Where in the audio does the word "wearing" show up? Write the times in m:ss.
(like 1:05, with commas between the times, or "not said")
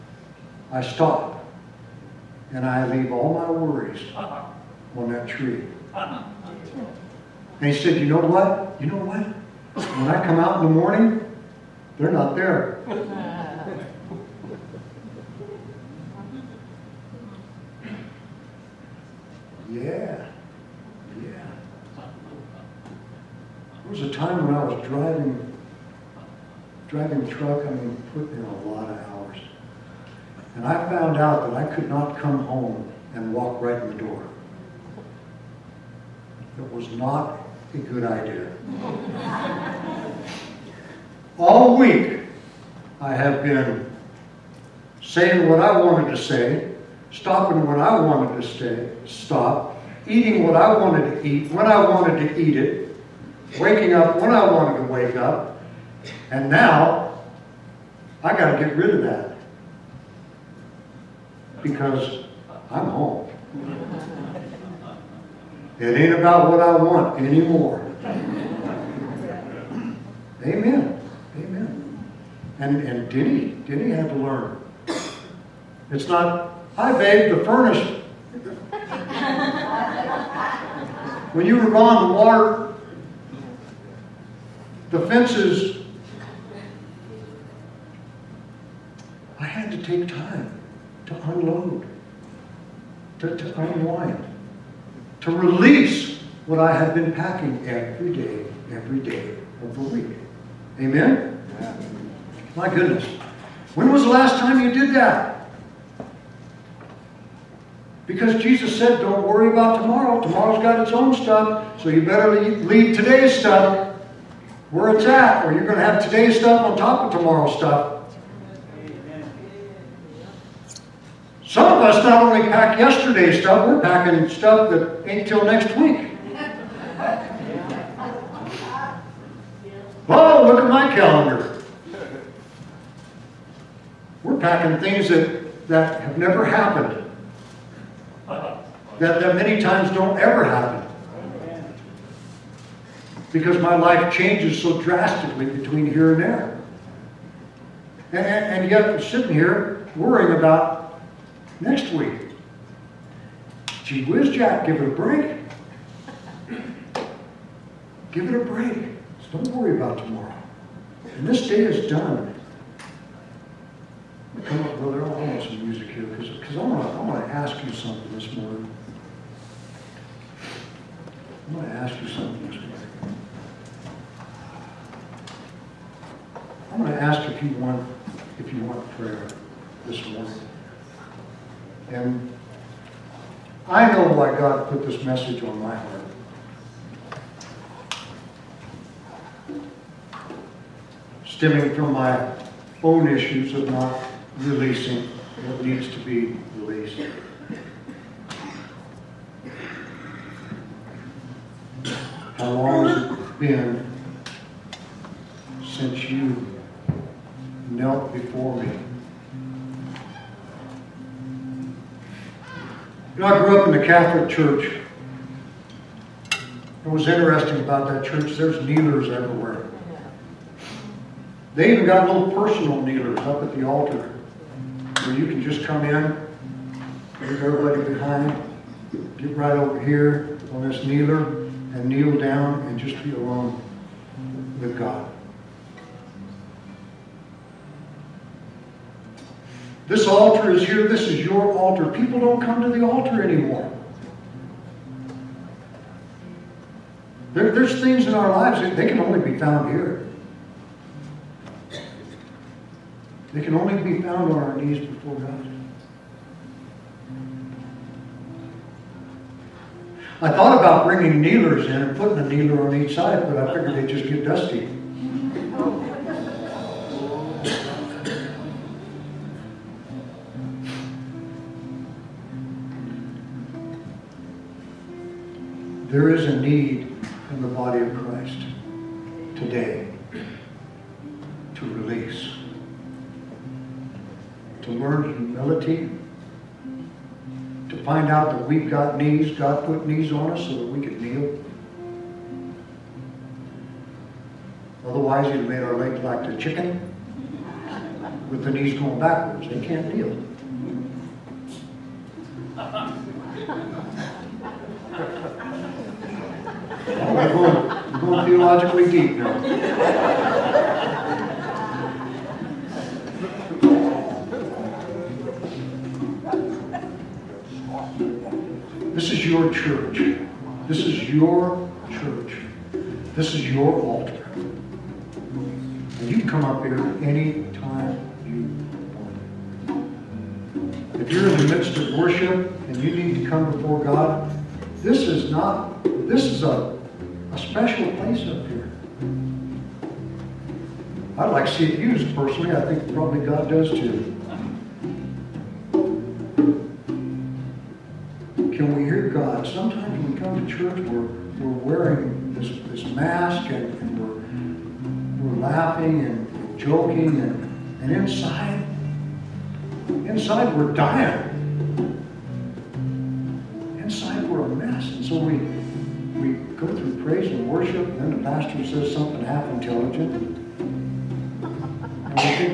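5:51.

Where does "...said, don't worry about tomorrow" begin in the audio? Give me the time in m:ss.
1:48.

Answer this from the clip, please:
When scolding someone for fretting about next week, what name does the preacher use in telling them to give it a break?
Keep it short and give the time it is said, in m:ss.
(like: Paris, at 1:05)
Jack, at 2:34.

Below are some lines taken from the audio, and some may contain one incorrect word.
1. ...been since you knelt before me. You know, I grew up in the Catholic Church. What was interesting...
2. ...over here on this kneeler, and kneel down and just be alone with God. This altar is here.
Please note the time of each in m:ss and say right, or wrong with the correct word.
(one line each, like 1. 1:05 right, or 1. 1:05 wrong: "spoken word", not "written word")
1. 3:23 right
2. 3:49 right.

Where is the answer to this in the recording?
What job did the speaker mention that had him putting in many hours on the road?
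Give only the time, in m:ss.
0:26.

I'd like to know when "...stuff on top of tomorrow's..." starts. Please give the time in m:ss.
1:56.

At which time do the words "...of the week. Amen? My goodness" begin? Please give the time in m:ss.
1:39.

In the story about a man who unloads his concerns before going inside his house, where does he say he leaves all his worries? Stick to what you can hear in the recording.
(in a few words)
On that tree.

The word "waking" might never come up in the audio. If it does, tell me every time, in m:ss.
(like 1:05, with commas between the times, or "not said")
0:53.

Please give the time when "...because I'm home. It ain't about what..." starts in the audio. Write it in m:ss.
1:01.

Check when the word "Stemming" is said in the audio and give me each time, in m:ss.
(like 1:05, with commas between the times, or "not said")
3:11.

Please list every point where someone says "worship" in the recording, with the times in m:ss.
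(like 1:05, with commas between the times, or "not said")
5:31, 6:07.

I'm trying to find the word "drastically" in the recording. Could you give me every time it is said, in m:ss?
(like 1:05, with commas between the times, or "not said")
2:24.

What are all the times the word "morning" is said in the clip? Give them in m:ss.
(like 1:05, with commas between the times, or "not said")
0:10, 2:48, 2:52, 3:00.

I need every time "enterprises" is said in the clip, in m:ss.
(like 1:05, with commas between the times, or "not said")
not said.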